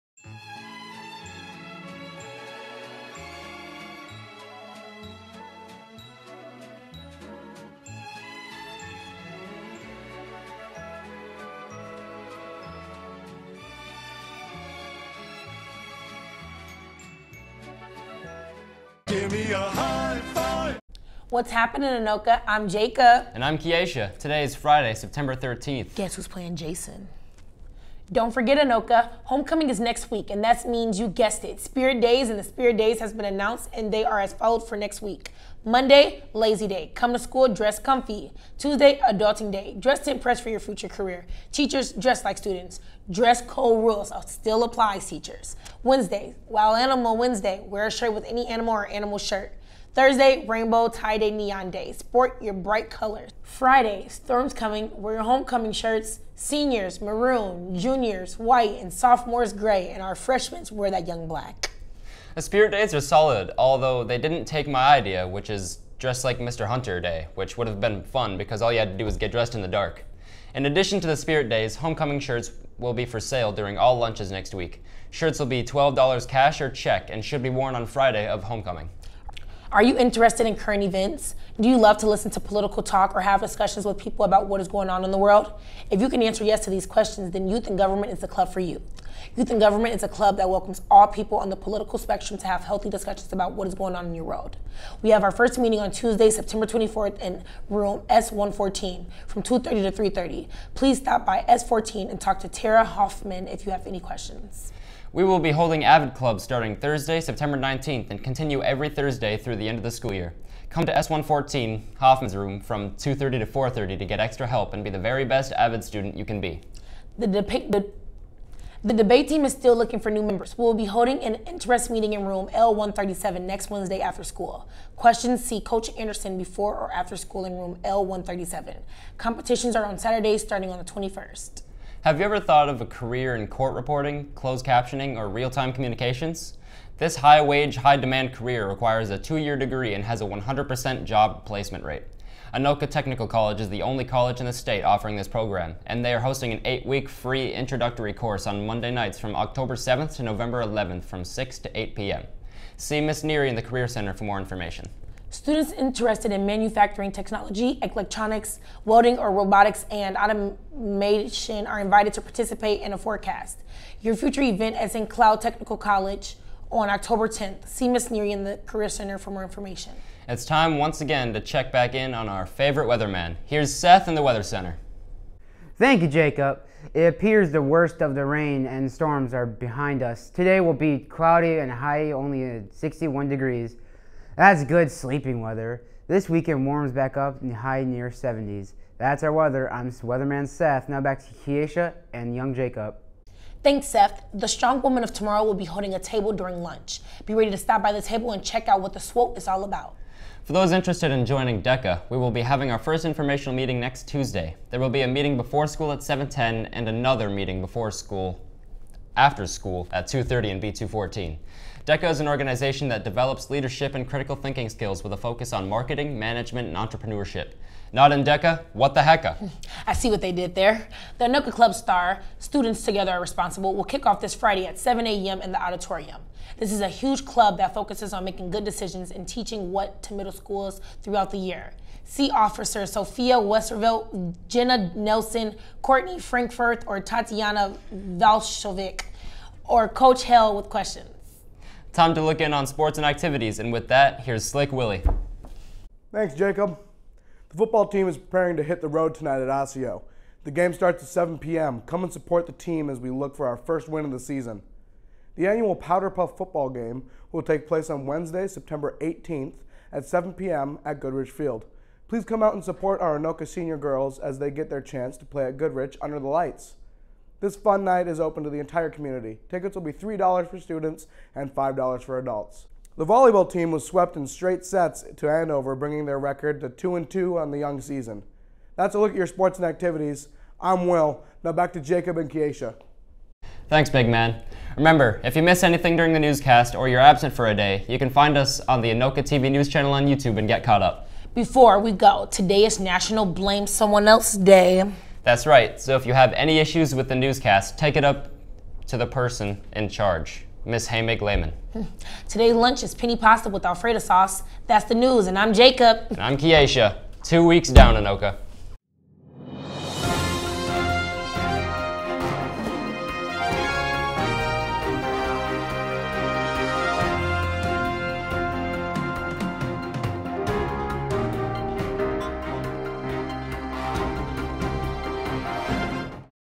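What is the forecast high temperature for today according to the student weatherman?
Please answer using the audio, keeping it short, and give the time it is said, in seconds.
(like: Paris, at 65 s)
61 degrees, at 182 s.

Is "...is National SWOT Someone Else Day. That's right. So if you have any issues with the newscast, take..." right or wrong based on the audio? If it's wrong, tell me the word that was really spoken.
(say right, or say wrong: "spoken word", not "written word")
wrong: "Blame", not "SWOT".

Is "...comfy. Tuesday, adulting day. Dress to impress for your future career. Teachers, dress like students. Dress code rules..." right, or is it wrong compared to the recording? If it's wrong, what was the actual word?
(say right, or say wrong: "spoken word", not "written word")
right.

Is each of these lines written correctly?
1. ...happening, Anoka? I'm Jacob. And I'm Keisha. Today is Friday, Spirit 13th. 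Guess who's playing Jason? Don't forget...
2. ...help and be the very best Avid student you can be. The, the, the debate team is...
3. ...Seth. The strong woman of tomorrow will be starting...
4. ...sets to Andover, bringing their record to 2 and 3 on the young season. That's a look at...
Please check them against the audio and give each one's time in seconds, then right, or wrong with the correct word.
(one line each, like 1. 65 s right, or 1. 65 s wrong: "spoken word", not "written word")
1. 21 s wrong: "September", not "Spirit"
2. 114 s right
3. 193 s wrong: "holding", not "starting"
4. 274 s wrong: "2", not "3".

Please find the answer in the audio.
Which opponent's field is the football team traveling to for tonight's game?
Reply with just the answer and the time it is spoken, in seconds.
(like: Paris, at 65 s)
Osseo, at 249 s.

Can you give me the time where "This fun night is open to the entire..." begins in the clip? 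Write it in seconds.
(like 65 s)
267 s.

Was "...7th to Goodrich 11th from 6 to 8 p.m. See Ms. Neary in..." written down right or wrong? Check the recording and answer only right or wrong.
wrong.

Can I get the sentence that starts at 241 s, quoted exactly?
Time to look in on sports and activities, and with that, here's Slick Willie.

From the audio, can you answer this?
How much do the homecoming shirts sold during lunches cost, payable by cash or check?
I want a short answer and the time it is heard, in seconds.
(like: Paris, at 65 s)
$12, at 75 s.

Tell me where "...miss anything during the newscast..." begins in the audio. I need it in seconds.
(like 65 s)
285 s.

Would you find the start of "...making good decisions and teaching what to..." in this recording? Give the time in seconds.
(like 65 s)
228 s.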